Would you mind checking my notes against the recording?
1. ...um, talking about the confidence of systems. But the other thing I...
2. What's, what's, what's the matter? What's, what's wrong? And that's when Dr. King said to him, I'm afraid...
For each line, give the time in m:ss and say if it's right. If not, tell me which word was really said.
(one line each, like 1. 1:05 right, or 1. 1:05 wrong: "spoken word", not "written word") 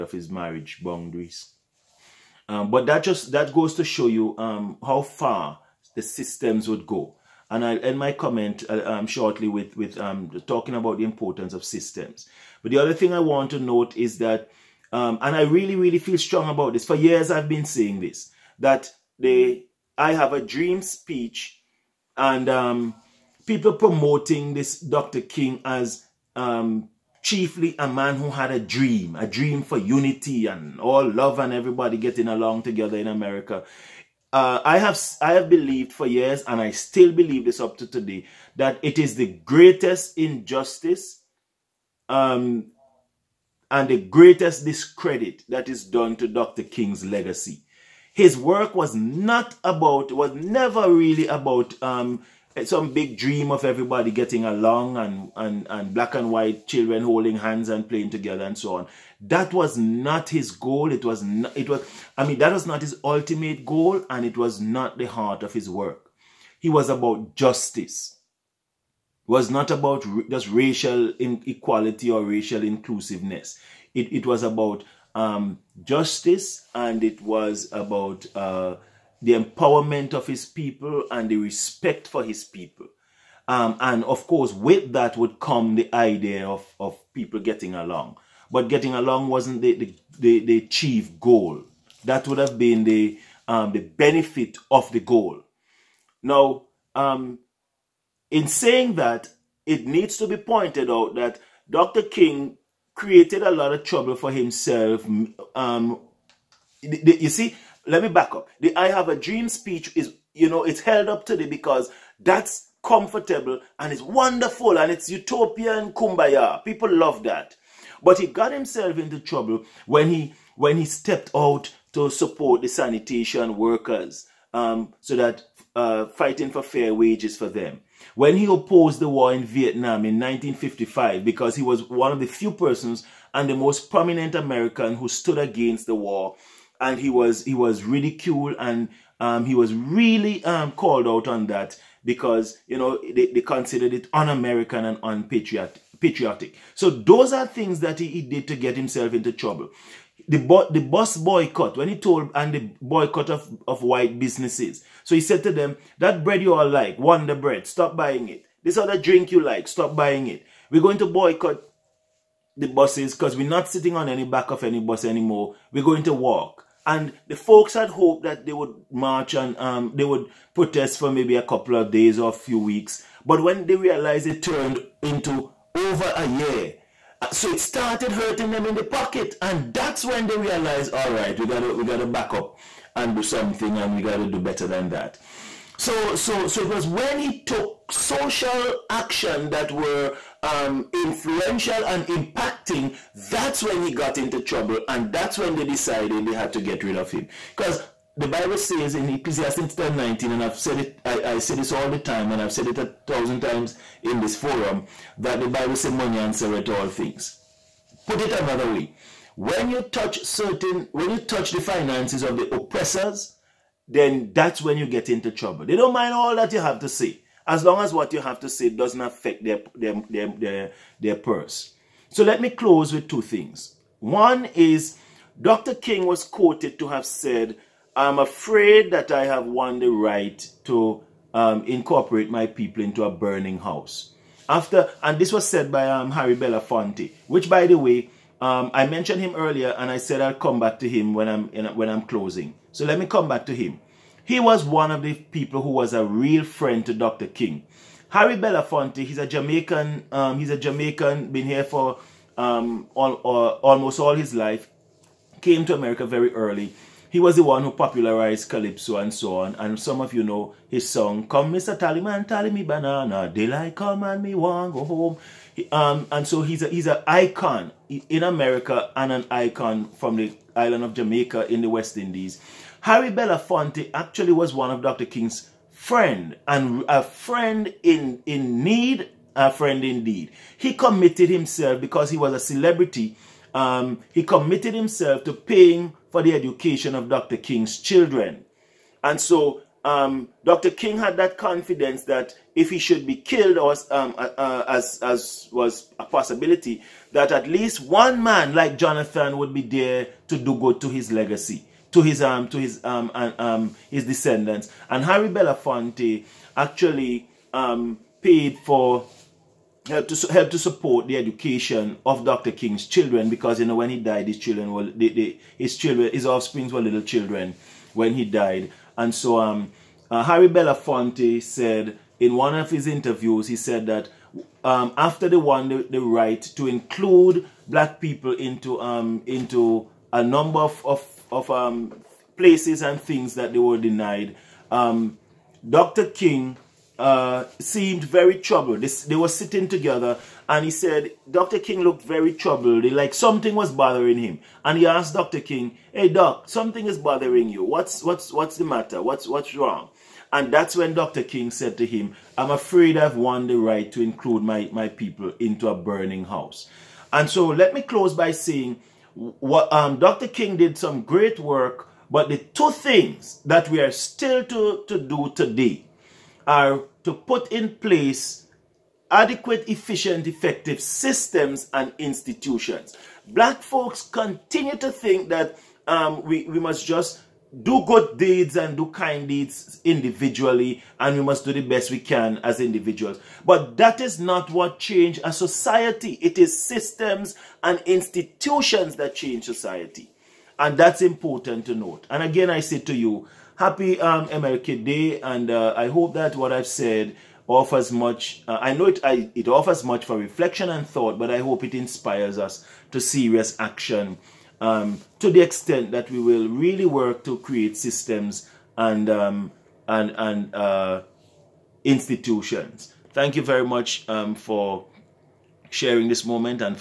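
1. 0:09 wrong: "importance", not "confidence"
2. 5:47 right.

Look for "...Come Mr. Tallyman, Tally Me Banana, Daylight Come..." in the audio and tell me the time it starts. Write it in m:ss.
4:21.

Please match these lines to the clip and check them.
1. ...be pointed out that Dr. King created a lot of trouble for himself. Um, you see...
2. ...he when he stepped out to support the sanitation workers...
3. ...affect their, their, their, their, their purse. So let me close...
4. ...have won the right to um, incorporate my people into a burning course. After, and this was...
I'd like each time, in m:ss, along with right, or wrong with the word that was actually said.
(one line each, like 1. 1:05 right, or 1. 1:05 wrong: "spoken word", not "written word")
1. 1:40 right
2. 2:00 right
3. 3:39 right
4. 3:49 wrong: "house", not "course".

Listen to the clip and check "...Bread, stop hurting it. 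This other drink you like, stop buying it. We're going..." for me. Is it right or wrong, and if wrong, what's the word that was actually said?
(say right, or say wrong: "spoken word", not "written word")
wrong: "buying", not "hurting".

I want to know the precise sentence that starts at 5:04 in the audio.
And Harry Belafonte actually um paid for help to help to support the education of Dr.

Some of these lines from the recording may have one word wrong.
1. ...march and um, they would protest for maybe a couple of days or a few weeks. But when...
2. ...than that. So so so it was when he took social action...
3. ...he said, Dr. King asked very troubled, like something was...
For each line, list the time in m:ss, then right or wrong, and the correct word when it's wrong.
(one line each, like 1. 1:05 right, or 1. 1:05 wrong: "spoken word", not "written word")
1. 2:48 right
2. 3:04 right
3. 5:40 wrong: "looked", not "asked".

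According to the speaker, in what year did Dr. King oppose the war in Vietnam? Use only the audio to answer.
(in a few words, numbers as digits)
1955.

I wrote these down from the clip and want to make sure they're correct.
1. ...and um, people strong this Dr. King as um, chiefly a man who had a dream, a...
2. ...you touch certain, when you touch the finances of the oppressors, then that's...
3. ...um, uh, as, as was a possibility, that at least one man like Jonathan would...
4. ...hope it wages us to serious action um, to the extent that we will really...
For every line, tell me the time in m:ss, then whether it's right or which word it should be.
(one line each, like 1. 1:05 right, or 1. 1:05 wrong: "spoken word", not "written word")
1. 0:22 wrong: "promoting", not "strong"
2. 3:29 right
3. 4:53 right
4. 6:41 wrong: "inspires", not "wages".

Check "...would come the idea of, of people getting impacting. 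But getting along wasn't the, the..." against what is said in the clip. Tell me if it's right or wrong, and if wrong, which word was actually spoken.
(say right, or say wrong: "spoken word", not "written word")
wrong: "along", not "impacting".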